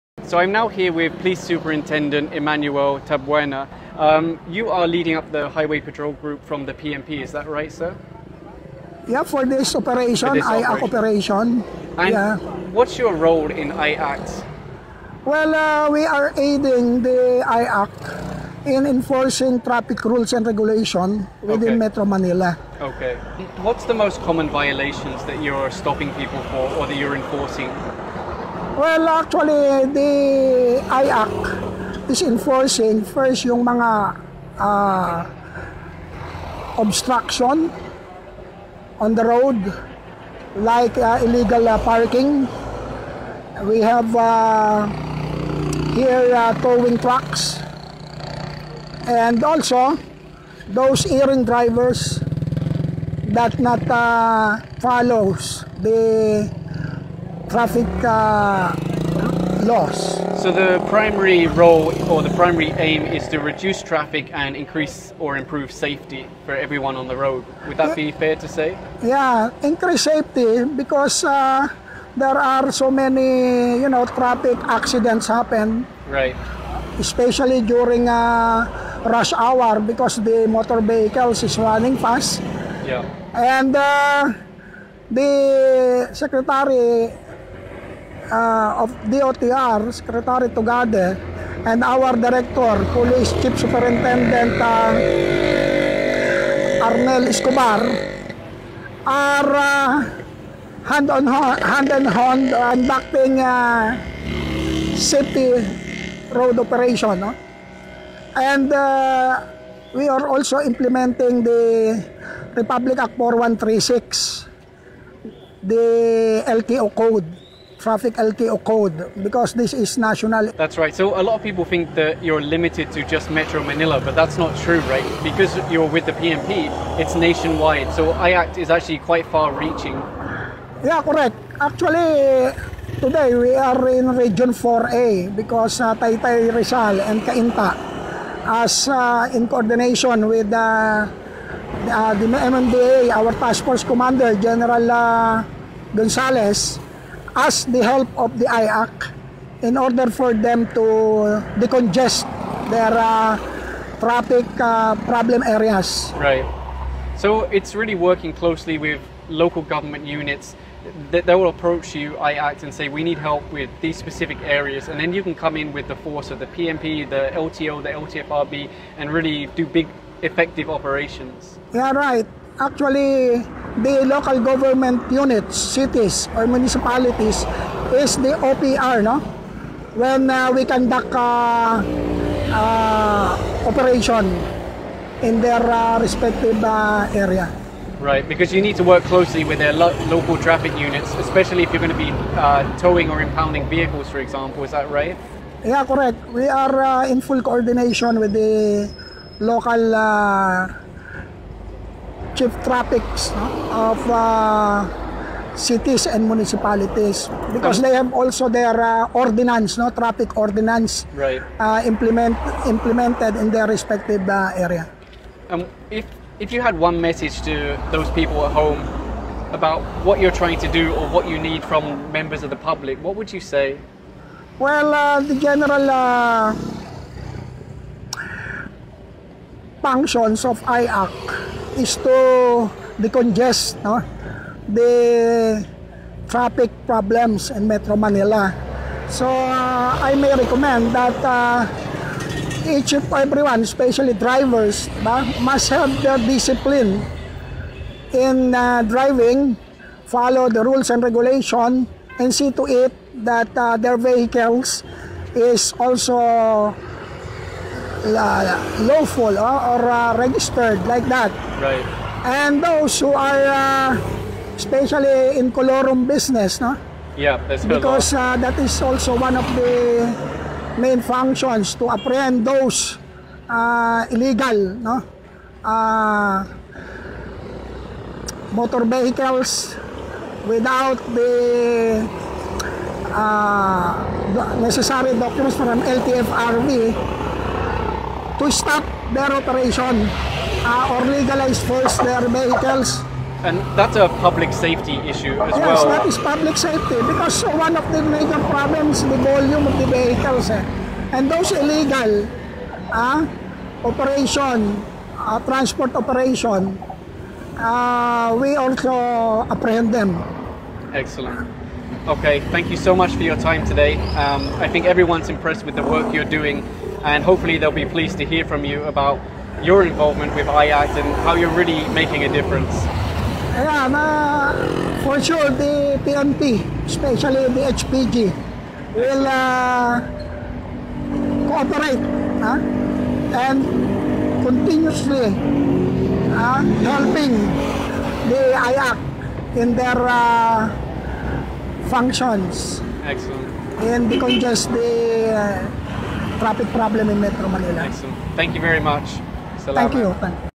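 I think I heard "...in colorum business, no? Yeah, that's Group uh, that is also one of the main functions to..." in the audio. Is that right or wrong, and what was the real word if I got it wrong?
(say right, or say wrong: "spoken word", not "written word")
wrong: "Because", not "Group".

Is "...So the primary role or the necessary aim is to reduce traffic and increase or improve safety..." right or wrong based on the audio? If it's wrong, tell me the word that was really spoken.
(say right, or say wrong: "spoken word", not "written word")
wrong: "primary", not "necessary".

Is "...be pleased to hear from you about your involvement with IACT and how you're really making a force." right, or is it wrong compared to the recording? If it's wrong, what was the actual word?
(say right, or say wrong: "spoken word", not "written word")
wrong: "difference", not "force".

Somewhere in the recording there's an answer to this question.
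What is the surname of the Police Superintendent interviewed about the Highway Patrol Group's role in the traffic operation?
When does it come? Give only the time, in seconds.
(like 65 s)
3 s.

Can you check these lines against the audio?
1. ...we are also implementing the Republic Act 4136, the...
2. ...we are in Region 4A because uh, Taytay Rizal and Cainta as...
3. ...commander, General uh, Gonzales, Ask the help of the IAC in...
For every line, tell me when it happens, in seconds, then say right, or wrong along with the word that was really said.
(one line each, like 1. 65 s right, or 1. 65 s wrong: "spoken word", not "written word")
1. 109 s right
2. 133 s right
3. 143 s right.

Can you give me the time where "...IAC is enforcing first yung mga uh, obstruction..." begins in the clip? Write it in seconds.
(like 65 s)
30 s.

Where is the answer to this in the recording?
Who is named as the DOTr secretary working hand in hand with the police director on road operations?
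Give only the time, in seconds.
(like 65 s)
89 s.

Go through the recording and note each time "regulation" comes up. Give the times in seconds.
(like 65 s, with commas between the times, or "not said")
20 s, 251 s.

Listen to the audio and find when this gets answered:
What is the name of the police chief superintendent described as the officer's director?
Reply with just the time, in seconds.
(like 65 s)
96 s.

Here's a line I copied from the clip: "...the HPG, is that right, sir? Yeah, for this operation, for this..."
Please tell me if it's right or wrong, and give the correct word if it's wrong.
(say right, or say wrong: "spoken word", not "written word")
wrong: "PNP", not "HPG".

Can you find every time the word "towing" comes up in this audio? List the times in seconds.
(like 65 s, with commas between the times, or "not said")
46 s, 192 s.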